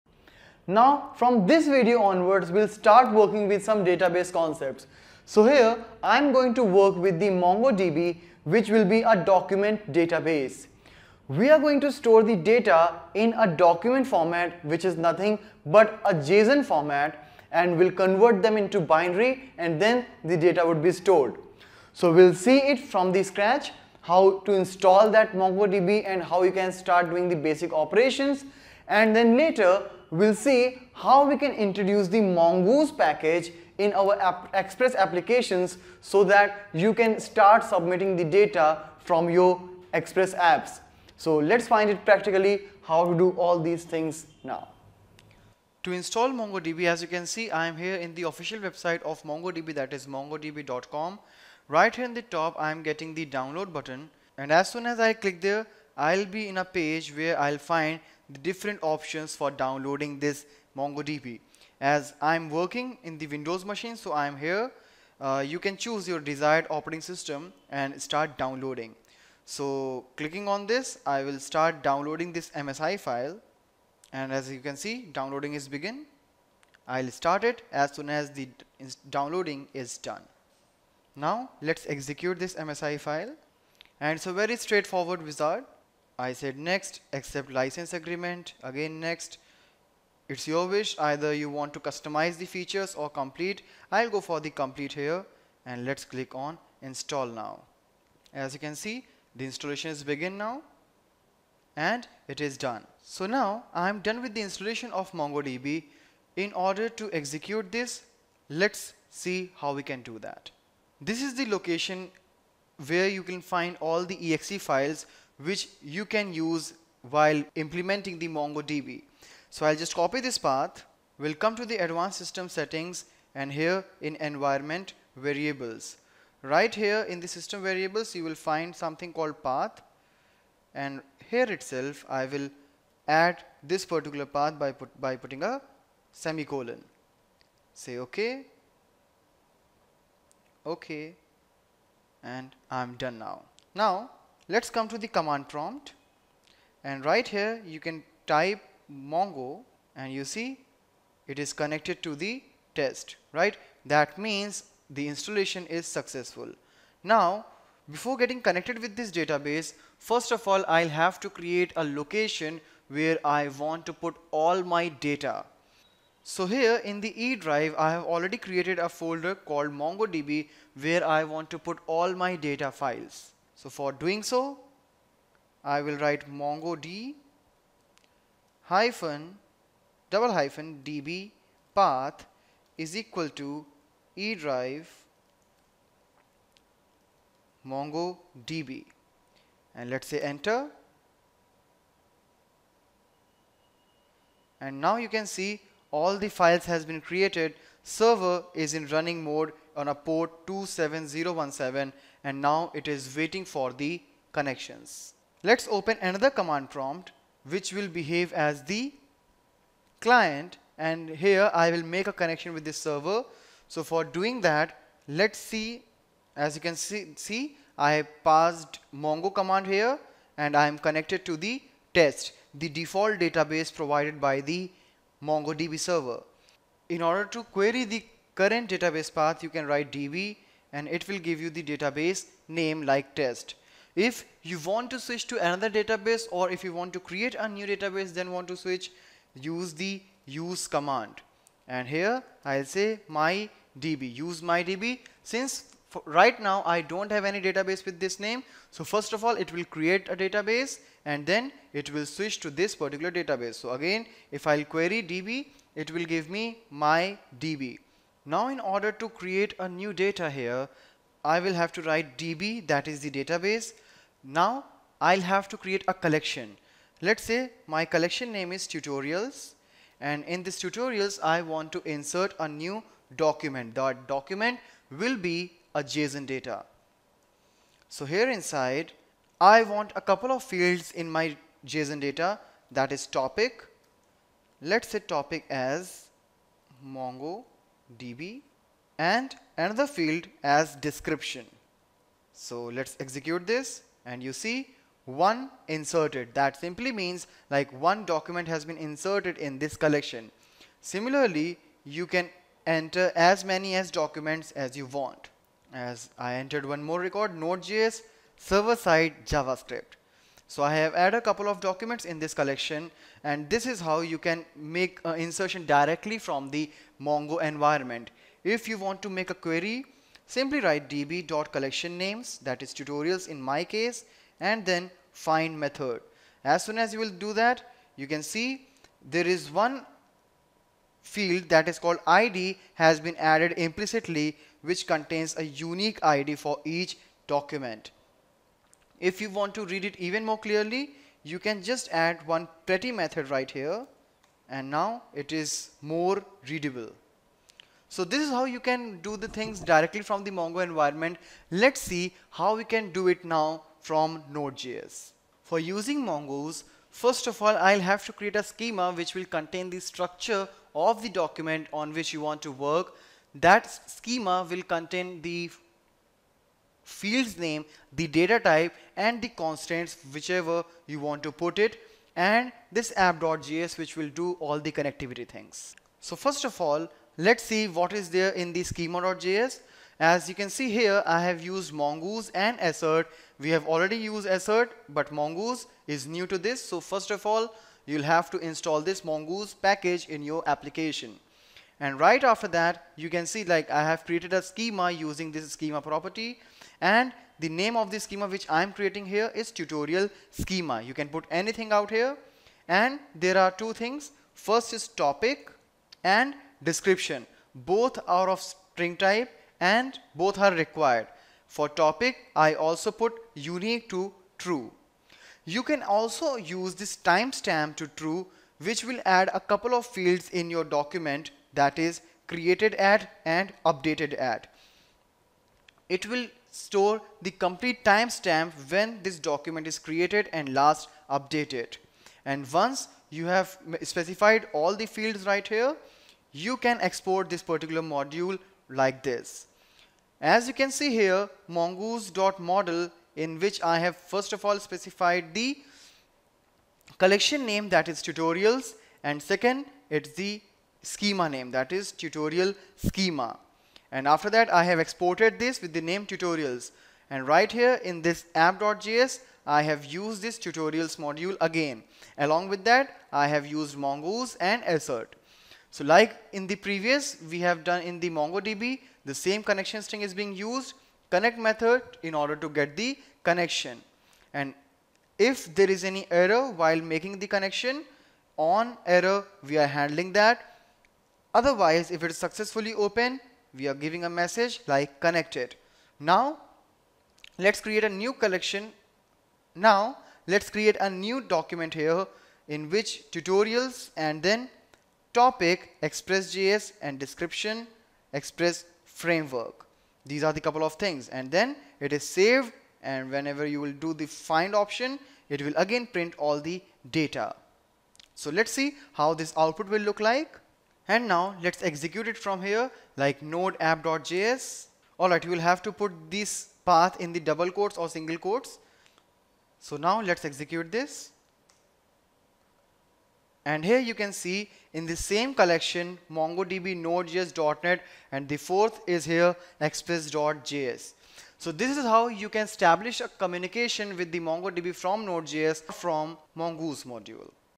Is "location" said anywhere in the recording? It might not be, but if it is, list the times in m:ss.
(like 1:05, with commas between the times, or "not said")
1:51, 2:41.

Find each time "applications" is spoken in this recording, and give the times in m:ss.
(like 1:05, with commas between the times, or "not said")
0:34, 6:30.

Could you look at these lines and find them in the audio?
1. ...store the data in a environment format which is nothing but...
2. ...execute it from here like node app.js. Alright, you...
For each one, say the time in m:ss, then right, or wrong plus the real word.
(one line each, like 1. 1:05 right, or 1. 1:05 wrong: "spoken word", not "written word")
1. 0:11 wrong: "document", not "environment"
2. 8:31 right.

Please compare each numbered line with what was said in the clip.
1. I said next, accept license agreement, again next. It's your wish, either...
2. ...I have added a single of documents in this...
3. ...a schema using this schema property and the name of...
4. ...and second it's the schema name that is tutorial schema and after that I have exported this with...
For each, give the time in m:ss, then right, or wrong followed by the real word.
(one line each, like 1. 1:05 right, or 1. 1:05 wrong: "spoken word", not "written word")
1. 1:26 right
2. 5:10 wrong: "couple", not "single"
3. 6:34 right
4. 7:29 right.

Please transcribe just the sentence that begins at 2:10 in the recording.
And here itself, I will add this particular path by, put, by putting a semicolon.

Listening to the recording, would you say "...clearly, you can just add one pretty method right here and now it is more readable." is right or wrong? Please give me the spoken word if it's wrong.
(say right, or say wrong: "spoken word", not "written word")
right.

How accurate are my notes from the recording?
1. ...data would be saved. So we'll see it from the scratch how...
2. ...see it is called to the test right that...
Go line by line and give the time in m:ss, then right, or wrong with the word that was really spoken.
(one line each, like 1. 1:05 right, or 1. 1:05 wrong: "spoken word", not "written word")
1. 0:20 wrong: "stored", not "saved"
2. 2:30 wrong: "connected", not "called".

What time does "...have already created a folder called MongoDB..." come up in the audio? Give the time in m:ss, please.
2:47.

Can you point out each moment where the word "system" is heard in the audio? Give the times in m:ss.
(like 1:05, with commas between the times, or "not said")
1:07, 2:02, 2:07.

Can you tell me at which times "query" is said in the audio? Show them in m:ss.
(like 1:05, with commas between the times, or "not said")
3:47, 4:14, 5:19.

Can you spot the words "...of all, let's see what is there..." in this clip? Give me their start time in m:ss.
6:16.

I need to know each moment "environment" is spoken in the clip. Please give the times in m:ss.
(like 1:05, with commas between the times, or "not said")
2:04, 5:17, 5:50.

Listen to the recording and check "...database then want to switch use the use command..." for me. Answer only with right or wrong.
right.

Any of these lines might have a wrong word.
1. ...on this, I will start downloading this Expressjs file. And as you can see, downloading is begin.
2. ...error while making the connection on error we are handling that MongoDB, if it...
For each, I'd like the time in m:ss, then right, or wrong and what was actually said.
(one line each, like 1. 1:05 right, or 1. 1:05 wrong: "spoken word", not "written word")
1. 1:10 wrong: "MSI", not "Expressjs"
2. 7:56 wrong: "Otherwise", not "MongoDB".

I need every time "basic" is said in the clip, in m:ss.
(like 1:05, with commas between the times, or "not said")
0:27.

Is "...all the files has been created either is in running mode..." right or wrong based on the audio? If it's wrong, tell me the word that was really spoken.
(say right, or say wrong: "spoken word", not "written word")
wrong: "server", not "either".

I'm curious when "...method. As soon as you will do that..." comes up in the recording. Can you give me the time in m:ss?
5:25.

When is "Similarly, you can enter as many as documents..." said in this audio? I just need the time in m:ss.
5:00.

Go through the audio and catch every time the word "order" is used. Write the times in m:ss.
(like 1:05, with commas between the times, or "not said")
1:46, 3:47, 4:18, 7:52.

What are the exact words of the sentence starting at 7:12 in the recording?
And once you have specified all the fields right here, you can export this particular module like this.